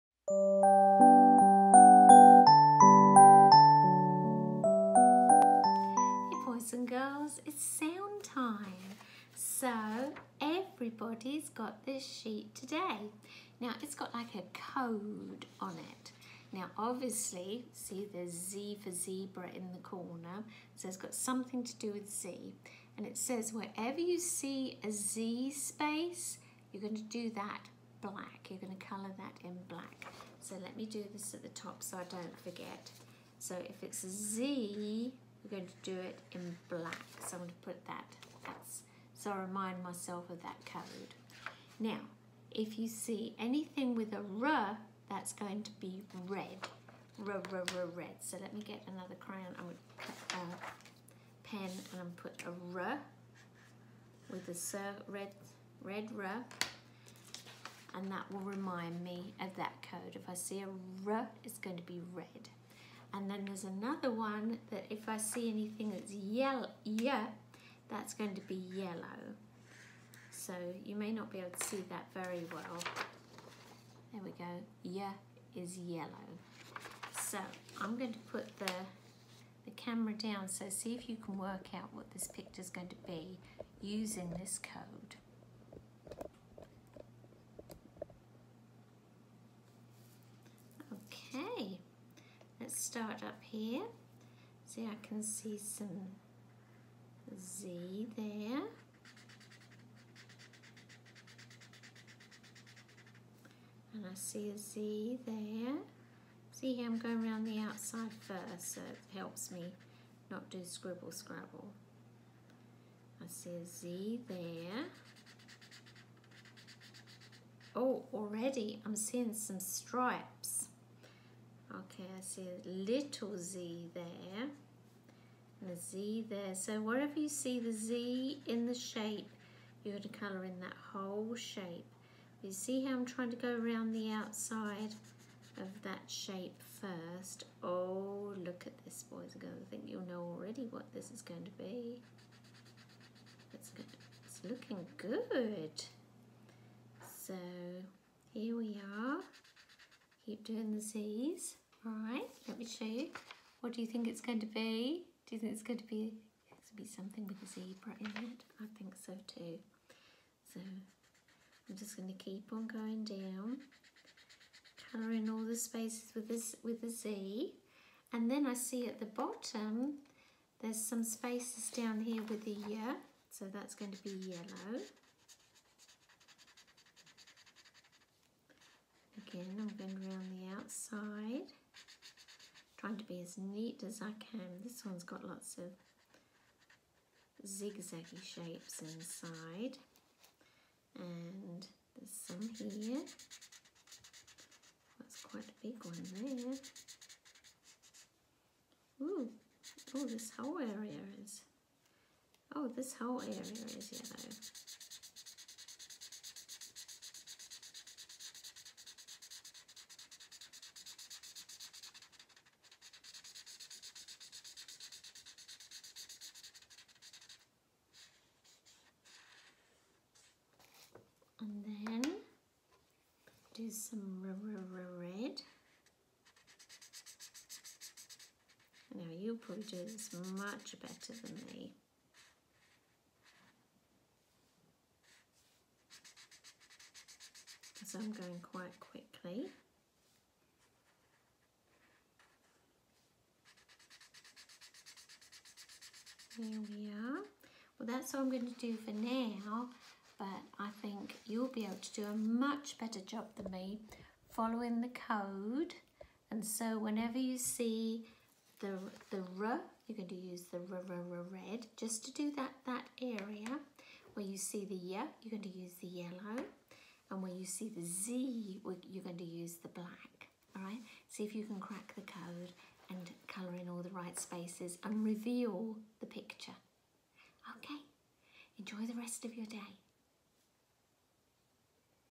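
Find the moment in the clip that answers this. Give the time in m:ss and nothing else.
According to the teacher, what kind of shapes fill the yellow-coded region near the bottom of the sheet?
3:07.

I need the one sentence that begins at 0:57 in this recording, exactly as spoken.
And that will remind me of that code.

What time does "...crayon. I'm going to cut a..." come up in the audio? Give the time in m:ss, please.
0:49.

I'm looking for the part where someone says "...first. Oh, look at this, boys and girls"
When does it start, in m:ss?
2:16.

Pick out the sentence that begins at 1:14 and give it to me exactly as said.
There we go, yeah is yellow.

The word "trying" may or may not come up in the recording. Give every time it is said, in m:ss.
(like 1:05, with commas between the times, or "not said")
2:13, 3:02.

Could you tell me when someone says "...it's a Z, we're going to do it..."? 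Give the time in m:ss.
0:33.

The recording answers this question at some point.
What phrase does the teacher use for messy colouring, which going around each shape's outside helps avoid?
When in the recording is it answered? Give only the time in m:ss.
1:50.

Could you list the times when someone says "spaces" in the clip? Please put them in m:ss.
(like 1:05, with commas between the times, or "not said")
0:25, 2:45, 2:51, 4:34.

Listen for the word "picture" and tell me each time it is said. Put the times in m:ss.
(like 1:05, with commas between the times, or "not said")
1:22, 4:36.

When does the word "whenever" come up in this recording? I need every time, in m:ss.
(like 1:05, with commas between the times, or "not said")
4:16.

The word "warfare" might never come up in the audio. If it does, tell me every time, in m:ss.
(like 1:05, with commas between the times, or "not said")
not said.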